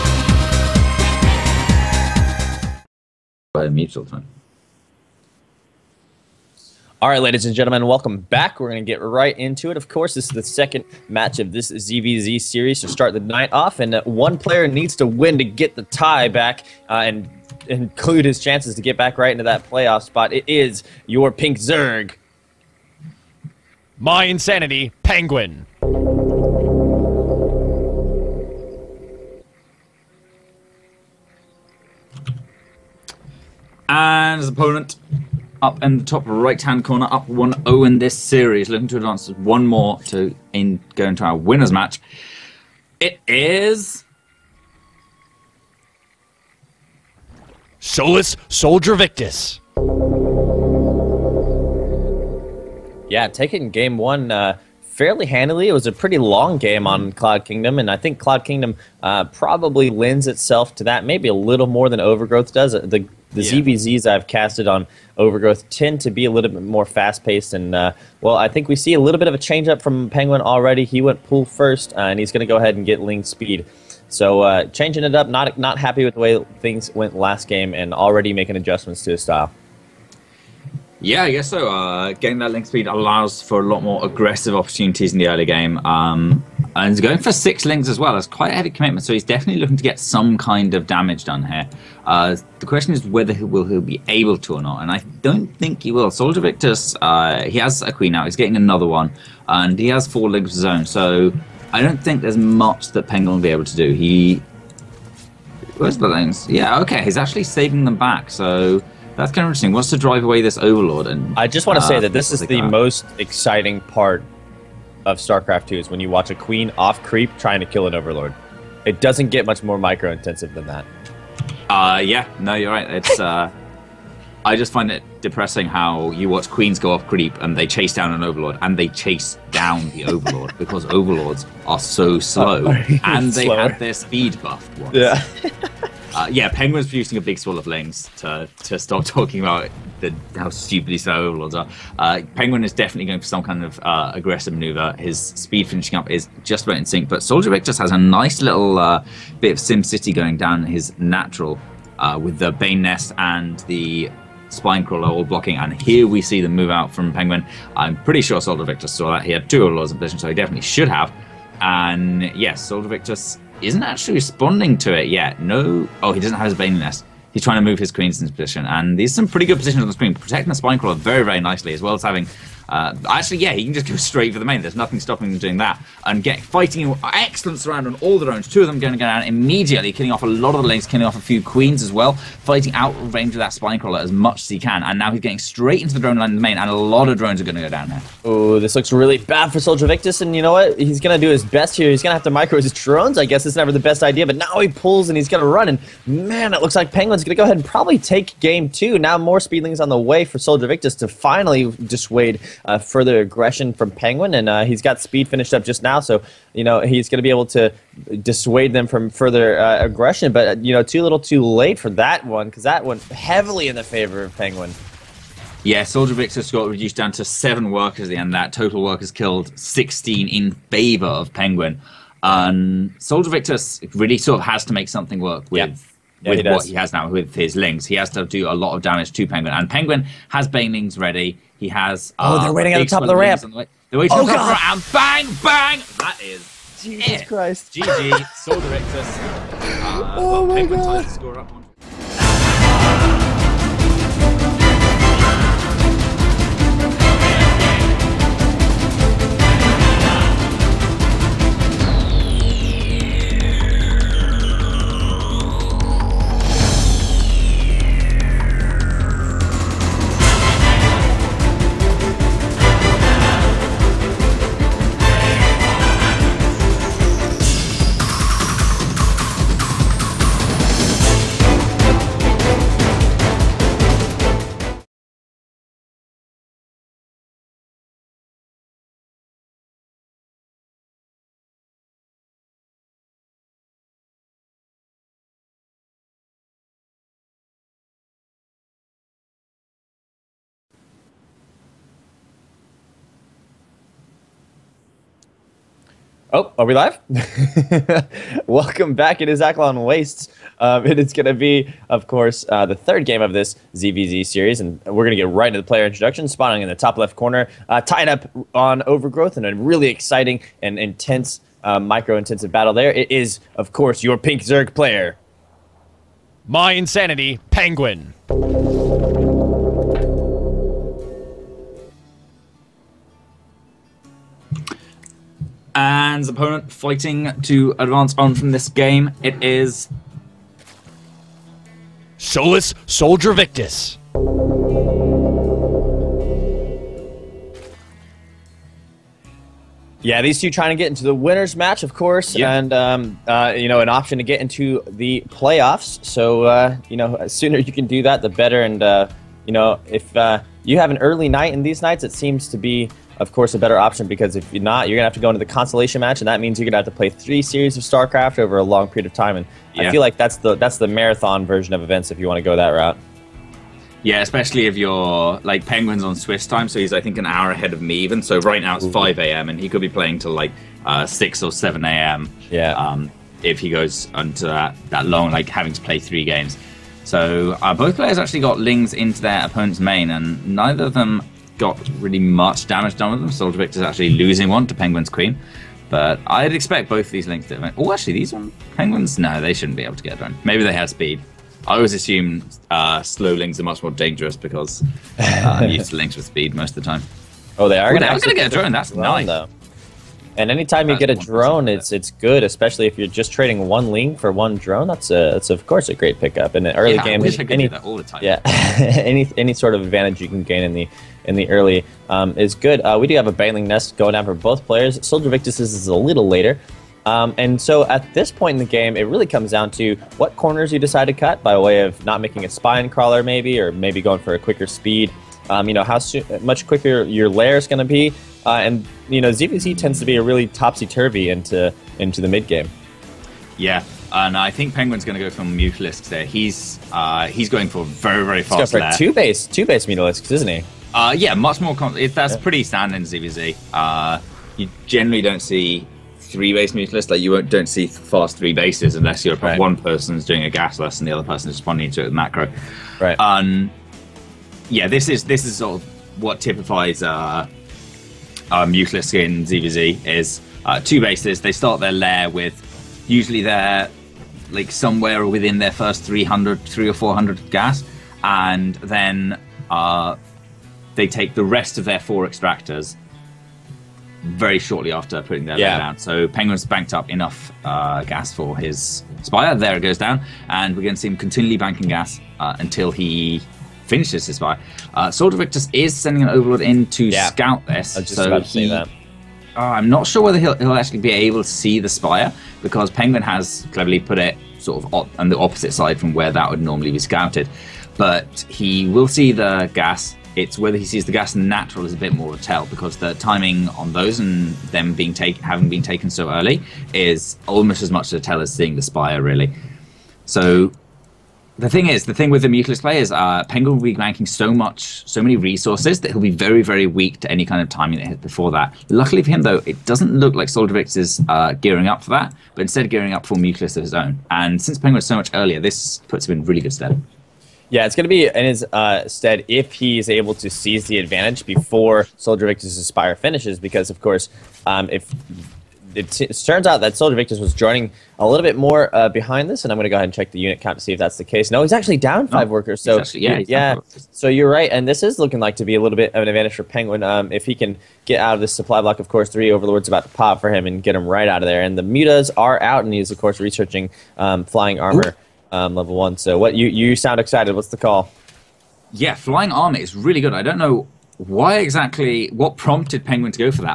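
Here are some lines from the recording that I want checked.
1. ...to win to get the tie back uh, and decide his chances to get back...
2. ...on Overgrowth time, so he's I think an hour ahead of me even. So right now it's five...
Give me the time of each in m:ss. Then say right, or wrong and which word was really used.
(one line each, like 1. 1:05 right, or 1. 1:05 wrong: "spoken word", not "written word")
1. 0:14 wrong: "include", not "decide"
2. 6:06 wrong: "Swiss", not "Overgrowth".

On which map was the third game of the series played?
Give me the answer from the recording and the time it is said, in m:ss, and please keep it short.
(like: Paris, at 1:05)
Akilon Wastes, at 4:59.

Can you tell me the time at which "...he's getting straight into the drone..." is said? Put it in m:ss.
3:05.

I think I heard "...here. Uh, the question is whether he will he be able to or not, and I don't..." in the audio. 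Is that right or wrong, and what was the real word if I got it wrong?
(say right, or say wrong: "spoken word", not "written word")
right.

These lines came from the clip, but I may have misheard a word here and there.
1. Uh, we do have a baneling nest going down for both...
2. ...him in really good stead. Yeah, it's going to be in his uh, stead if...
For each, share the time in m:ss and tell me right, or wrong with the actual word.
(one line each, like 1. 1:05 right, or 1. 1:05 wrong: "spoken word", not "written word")
1. 6:52 right
2. 8:46 right.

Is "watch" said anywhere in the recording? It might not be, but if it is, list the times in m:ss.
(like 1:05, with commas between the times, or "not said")
1:56, 2:06.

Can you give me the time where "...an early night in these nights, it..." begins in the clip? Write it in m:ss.
5:50.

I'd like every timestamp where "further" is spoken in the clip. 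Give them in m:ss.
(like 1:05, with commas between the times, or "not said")
3:22, 3:29.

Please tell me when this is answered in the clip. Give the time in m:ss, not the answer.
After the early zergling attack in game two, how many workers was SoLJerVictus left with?
3:37.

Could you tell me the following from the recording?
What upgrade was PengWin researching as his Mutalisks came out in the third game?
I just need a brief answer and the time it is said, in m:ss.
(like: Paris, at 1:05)
Flying armor level 1, at 9:14.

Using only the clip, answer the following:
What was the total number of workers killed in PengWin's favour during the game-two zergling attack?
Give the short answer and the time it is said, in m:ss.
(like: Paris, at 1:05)
16, at 3:39.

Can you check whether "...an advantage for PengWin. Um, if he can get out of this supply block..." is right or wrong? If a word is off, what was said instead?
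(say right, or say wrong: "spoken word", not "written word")
right.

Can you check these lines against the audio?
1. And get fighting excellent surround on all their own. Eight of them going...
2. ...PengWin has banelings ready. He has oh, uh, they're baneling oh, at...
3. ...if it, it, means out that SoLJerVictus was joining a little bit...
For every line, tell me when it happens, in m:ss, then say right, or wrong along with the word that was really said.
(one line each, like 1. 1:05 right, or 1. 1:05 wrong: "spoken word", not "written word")
1. 2:56 wrong: "Two", not "Eight"
2. 3:49 wrong: "waiting", not "baneling"
3. 8:54 wrong: "turns", not "means".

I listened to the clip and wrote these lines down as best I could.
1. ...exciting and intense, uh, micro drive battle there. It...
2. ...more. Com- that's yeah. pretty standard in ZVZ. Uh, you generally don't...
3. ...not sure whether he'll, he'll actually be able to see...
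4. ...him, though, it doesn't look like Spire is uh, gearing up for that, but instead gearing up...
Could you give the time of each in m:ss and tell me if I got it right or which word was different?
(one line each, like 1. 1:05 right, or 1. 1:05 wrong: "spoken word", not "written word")
1. 5:09 wrong: "intensive", not "drive"
2. 7:21 right
3. 8:09 right
4. 8:39 wrong: "Soldervix", not "Spire".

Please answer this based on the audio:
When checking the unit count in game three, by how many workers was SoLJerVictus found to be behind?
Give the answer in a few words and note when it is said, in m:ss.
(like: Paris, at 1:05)
5, at 9:02.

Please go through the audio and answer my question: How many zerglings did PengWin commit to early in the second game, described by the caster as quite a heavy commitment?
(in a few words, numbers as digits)
6.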